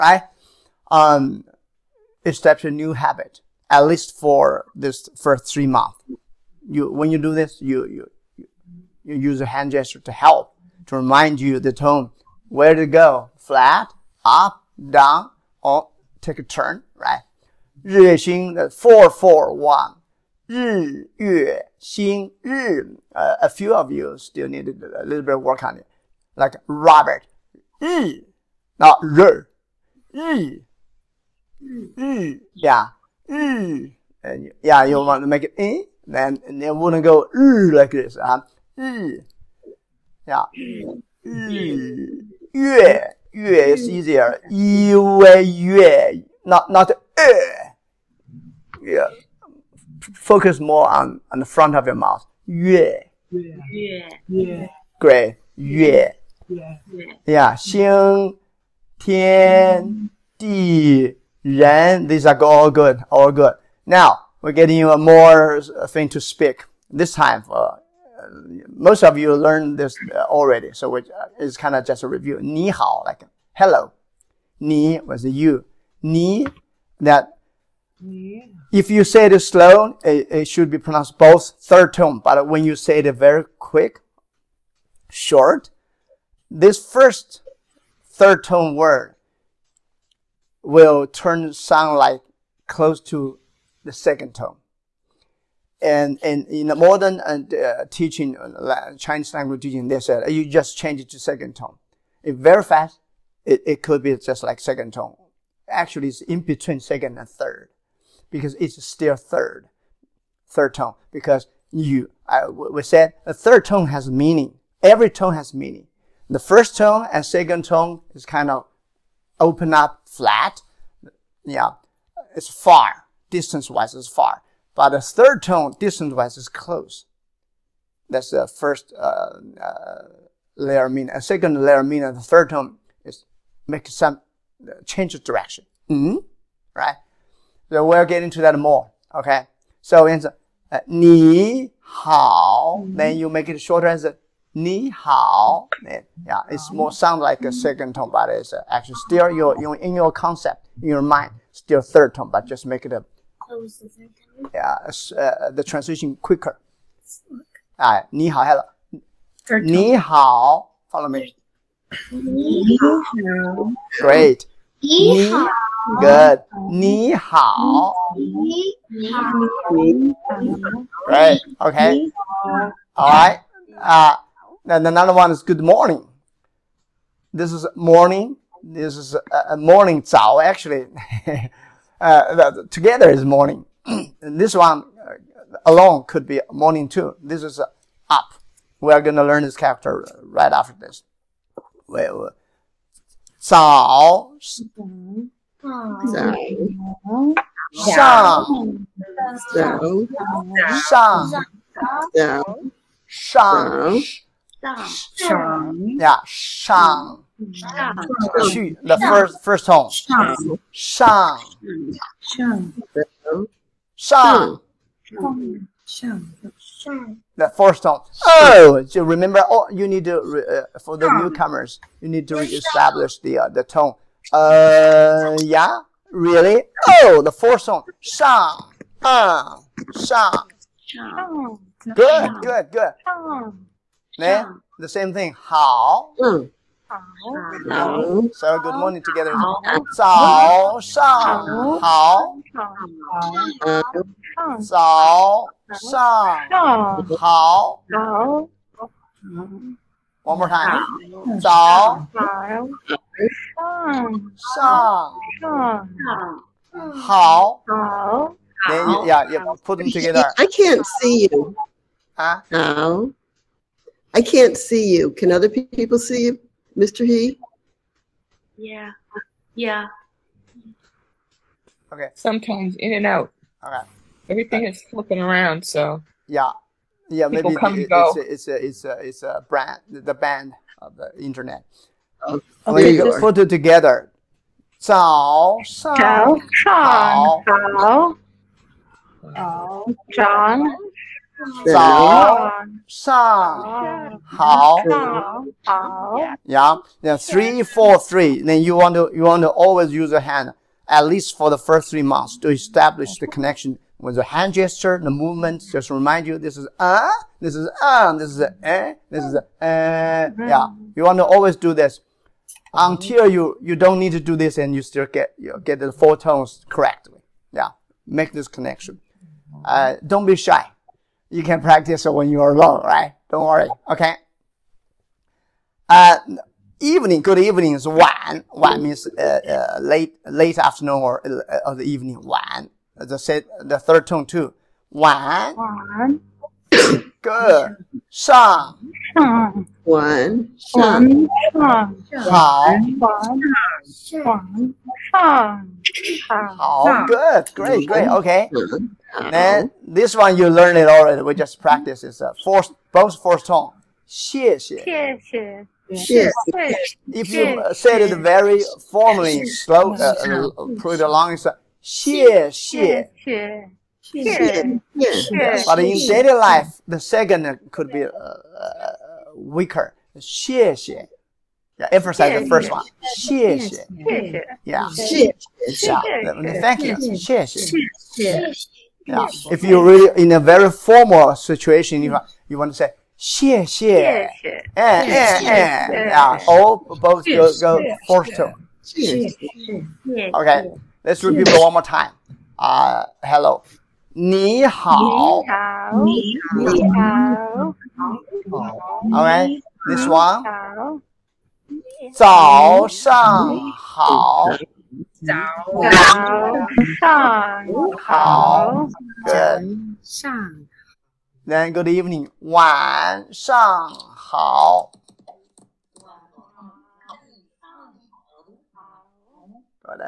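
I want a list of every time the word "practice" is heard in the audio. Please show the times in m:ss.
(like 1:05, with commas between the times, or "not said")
5:21, 5:51.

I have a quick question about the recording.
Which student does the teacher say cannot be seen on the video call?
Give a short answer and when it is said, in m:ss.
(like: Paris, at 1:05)
Mr. He, at 4:26.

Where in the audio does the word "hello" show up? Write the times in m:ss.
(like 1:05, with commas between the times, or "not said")
1:13, 2:38, 6:33.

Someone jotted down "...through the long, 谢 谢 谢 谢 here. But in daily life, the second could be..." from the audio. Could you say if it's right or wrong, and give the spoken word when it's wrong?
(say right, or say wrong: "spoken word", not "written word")
right.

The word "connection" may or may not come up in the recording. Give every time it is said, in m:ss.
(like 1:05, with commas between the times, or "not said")
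5:03, 5:18.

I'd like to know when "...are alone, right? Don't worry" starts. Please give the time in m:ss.
5:22.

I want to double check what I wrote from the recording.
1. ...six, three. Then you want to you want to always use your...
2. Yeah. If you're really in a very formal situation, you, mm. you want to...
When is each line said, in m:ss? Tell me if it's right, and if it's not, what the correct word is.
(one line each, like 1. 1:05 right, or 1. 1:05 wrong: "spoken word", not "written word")
1. 4:57 wrong: "four", not "six"
2. 6:19 right.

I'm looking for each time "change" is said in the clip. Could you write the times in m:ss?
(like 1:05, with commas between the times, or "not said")
1:40, 2:14.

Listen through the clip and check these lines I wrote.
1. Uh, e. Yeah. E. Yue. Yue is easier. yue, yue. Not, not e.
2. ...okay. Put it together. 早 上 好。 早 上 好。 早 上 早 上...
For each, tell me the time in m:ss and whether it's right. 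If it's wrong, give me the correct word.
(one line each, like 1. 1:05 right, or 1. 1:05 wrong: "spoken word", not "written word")
1. 0:38 right
2. 4:42 right.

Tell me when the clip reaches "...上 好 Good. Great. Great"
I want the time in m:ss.
5:46.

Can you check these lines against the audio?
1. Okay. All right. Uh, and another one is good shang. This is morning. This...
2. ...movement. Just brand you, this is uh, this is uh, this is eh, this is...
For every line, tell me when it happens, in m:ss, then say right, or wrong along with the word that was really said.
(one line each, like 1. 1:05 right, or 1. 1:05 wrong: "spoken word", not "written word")
1. 2:51 wrong: "morning", not "shang"
2. 5:05 wrong: "remind", not "brand".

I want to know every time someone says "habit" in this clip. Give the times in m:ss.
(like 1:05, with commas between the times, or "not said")
0:02.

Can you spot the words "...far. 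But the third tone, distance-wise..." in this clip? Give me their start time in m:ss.
2:04.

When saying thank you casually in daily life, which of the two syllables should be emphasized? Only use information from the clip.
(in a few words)
the first one.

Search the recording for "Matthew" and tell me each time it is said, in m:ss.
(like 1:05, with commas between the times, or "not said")
not said.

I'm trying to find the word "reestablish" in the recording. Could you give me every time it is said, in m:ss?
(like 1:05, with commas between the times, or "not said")
3:42.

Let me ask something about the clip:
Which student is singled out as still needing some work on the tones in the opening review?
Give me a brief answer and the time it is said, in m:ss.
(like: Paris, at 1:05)
Robert, at 0:26.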